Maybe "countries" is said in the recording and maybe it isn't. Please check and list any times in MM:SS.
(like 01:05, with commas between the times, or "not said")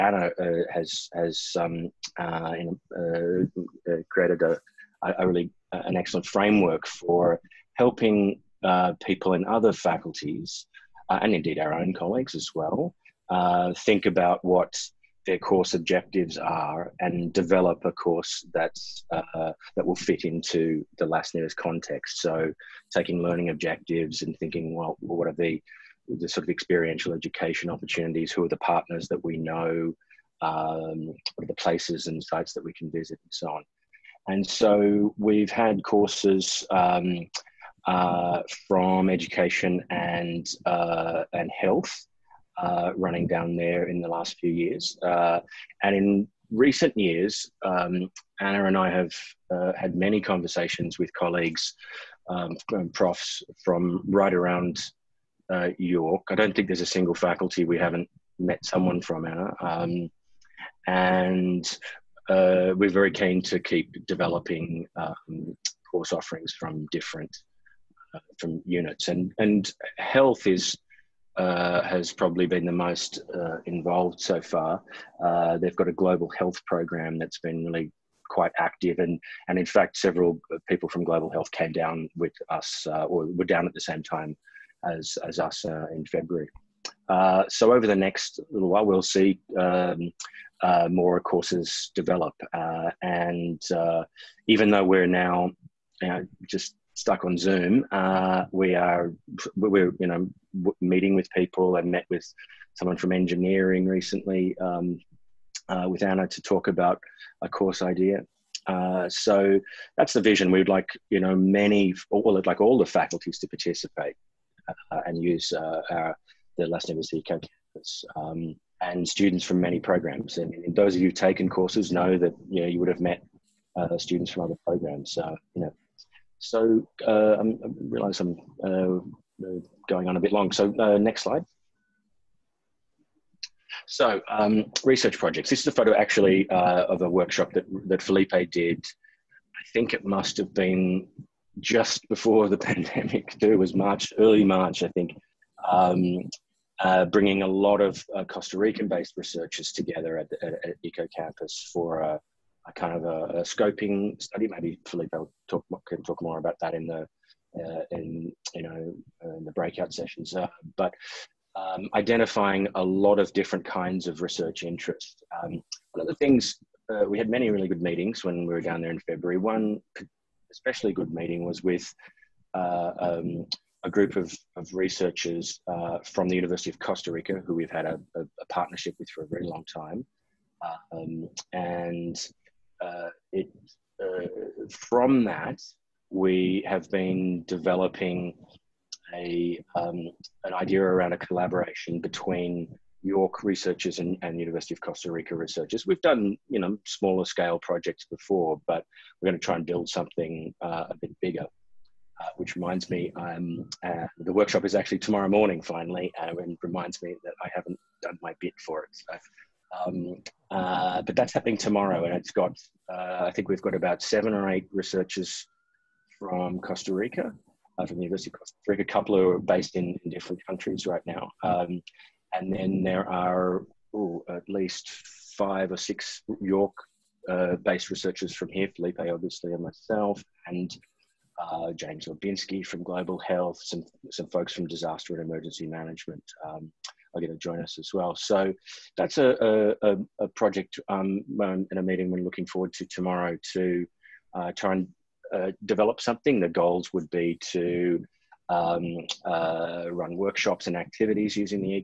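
03:40.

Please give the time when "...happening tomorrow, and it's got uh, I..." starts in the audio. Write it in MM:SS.
03:31.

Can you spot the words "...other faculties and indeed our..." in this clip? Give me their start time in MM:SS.
00:09.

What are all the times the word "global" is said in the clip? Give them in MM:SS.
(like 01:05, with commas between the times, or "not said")
01:15, 01:21, 03:52.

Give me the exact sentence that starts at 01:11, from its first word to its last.
Uh, has probably been the most uh, involved so far.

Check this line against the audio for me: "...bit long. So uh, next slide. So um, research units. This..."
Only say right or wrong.
wrong.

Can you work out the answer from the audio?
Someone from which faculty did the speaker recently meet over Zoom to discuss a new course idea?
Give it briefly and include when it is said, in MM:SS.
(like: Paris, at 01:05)
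Engineering, at 01:43.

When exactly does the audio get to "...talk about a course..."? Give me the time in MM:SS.
01:46.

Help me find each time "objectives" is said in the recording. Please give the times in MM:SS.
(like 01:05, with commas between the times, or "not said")
00:15, 00:23.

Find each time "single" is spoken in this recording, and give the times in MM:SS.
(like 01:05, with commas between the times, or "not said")
00:56.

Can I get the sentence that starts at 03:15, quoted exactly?
We've done you know smaller scale projects before, but we're going to try and build something uh, a bit bigger.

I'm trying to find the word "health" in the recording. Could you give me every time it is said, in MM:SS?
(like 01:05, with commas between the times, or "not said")
00:41, 01:09, 01:16, 01:21, 03:53.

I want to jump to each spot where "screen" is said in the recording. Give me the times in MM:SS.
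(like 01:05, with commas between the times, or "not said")
not said.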